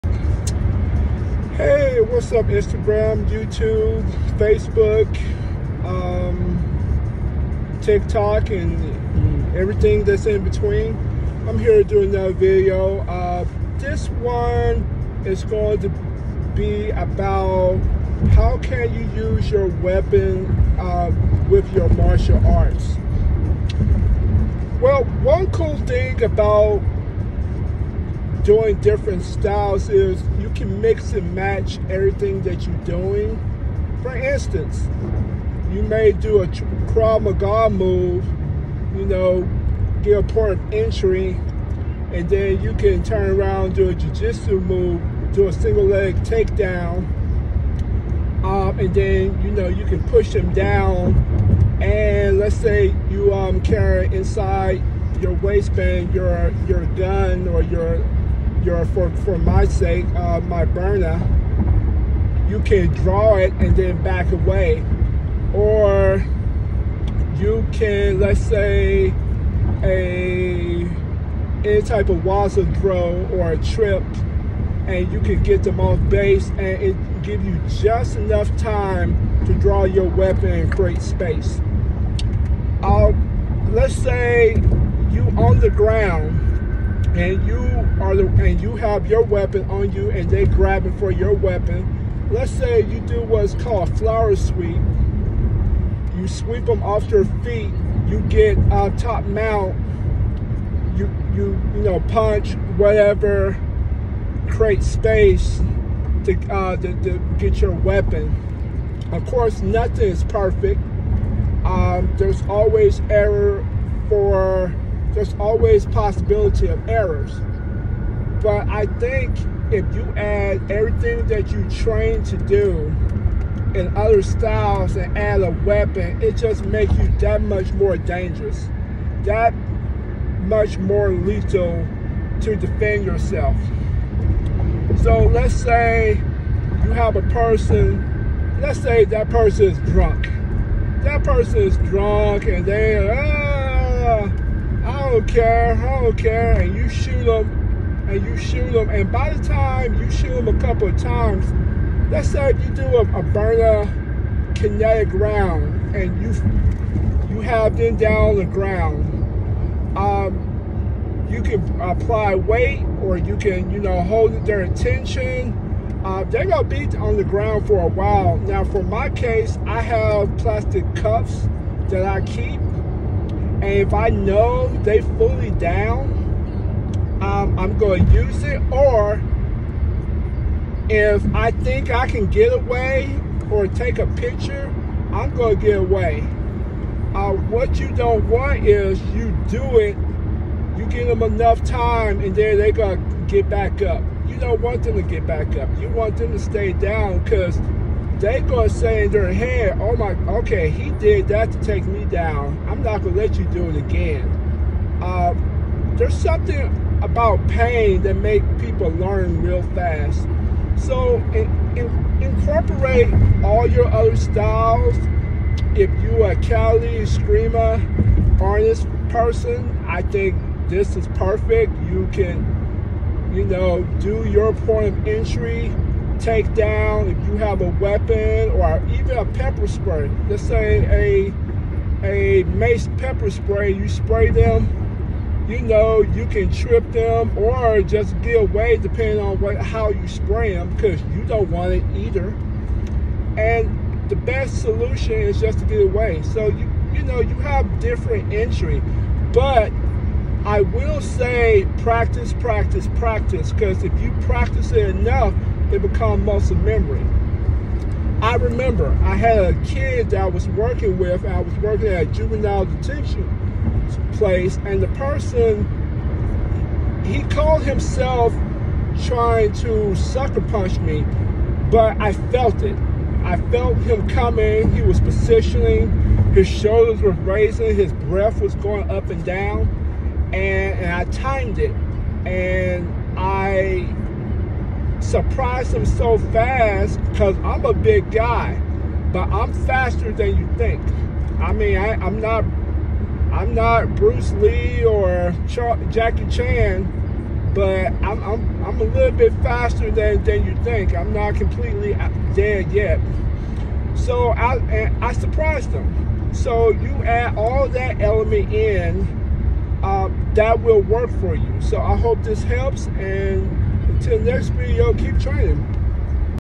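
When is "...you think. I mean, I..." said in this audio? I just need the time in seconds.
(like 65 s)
290 s.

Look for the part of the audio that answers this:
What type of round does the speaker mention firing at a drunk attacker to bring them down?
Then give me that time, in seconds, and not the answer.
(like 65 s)
154 s.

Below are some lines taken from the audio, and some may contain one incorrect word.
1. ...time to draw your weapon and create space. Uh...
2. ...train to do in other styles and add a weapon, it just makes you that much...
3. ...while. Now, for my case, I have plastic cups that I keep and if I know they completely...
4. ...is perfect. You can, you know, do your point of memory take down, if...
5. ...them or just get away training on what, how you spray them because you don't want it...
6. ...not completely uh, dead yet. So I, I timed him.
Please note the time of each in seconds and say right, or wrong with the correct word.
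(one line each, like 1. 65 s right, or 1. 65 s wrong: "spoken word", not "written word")
1. 78 s right
2. 121 s right
3. 167 s wrong: "fully", not "completely"
4. 220 s wrong: "entry", not "memory"
5. 236 s wrong: "depending", not "training"
6. 301 s wrong: "surprised", not "timed".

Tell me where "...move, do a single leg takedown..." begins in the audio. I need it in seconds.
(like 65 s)
44 s.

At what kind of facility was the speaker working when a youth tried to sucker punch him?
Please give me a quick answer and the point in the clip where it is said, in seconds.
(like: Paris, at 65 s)
juvenile detention place, at 262 s.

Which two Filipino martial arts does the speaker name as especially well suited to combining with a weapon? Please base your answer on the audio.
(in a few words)
Kali, Escrima.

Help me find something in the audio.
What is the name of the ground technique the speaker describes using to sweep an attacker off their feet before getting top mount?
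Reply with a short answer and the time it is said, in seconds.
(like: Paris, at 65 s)
flower sweep, at 93 s.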